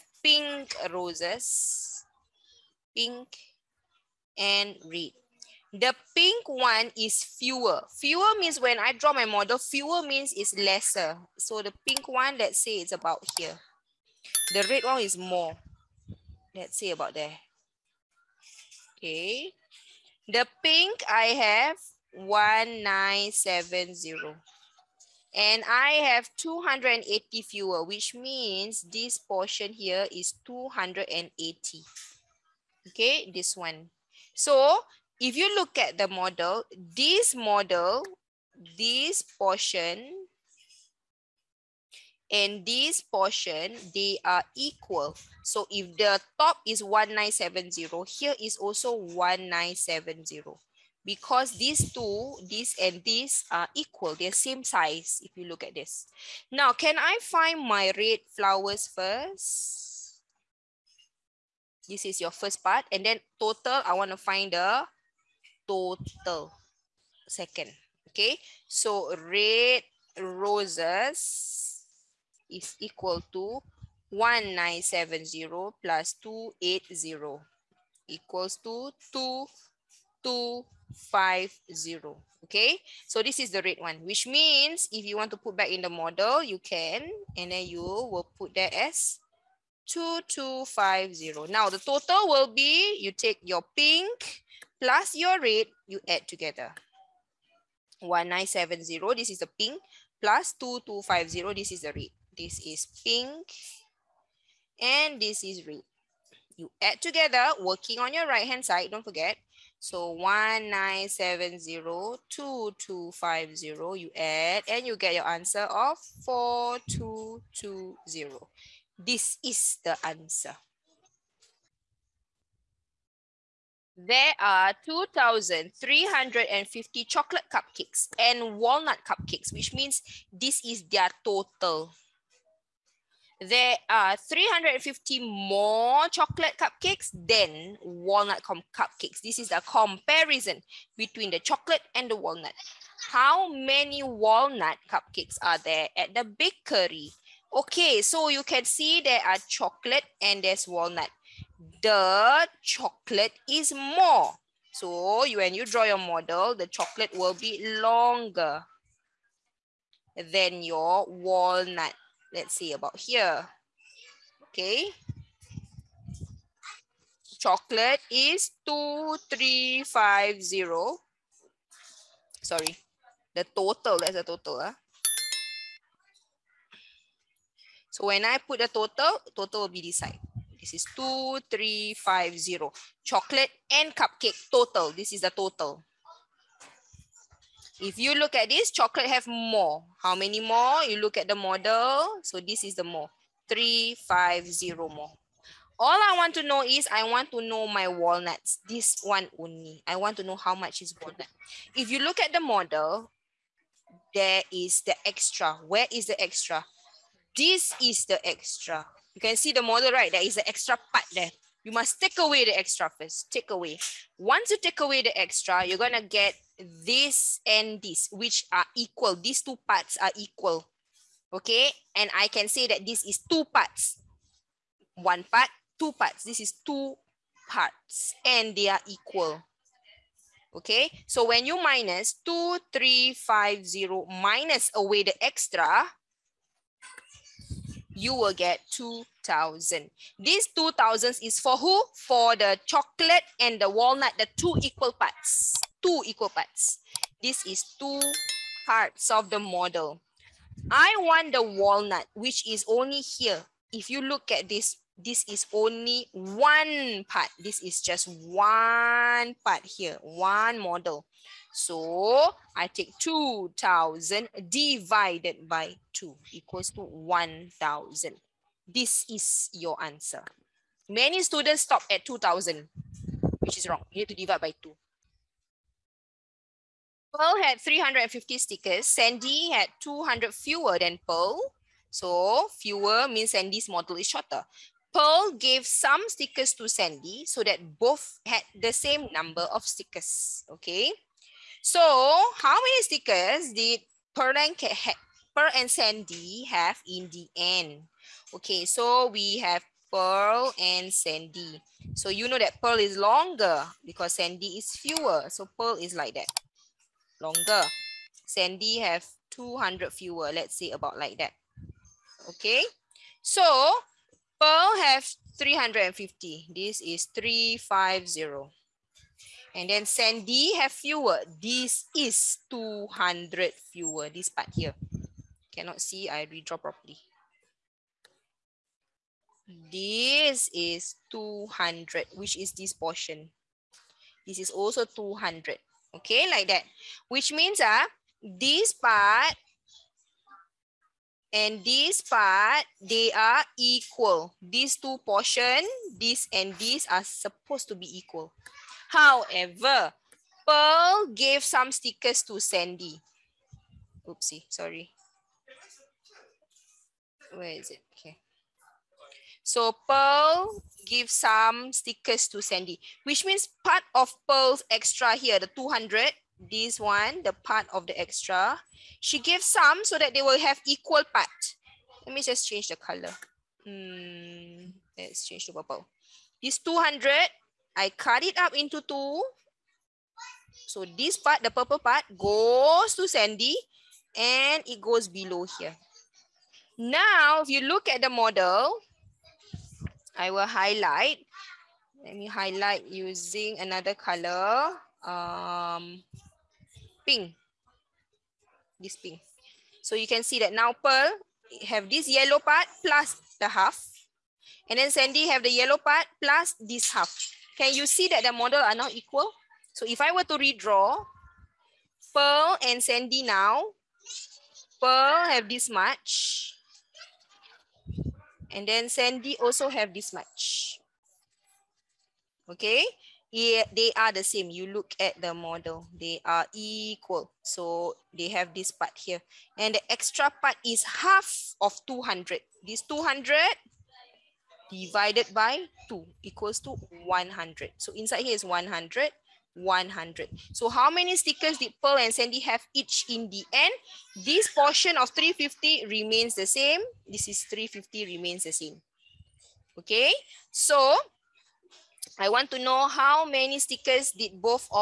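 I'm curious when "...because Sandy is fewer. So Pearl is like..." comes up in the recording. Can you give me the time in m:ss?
5:03.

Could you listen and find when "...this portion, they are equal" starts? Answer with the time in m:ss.
0:42.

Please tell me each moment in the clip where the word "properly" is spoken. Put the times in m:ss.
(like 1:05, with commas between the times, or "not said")
5:26.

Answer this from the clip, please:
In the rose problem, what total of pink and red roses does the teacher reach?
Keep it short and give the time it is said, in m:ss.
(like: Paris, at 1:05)
4220, at 1:56.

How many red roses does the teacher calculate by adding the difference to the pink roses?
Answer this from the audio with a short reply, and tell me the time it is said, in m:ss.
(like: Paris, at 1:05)
2250, at 1:14.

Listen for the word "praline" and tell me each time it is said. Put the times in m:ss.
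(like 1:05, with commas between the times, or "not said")
not said.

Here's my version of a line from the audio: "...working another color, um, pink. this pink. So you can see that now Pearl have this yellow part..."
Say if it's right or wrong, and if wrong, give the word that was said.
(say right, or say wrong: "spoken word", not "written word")
wrong: "using", not "working".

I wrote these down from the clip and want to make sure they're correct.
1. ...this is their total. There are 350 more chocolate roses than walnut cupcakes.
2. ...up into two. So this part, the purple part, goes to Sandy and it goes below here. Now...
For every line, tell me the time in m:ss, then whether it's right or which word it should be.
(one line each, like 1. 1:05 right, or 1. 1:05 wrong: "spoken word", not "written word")
1. 2:10 wrong: "cupcakes", not "roses"
2. 6:18 right.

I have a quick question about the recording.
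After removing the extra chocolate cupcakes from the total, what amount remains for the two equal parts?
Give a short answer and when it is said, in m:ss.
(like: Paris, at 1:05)
2,000, at 3:57.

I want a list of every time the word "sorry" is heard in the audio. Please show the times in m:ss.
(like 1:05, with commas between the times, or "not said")
2:52, 5:54.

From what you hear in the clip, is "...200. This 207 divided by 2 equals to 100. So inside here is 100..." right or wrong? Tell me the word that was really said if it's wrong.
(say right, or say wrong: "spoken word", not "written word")
wrong: "200", not "207".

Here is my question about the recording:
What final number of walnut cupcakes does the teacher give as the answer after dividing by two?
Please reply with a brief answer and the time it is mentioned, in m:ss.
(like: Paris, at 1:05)
1,000, at 4:26.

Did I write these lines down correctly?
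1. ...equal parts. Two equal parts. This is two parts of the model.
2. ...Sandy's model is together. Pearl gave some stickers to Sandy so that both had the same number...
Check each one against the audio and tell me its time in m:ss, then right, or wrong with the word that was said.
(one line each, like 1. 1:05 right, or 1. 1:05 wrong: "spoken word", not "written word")
1. 4:04 right
2. 4:43 wrong: "shorter", not "together".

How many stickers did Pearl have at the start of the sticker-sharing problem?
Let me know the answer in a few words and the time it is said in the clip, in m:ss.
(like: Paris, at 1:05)
350, at 4:37.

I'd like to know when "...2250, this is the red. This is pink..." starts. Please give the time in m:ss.
1:40.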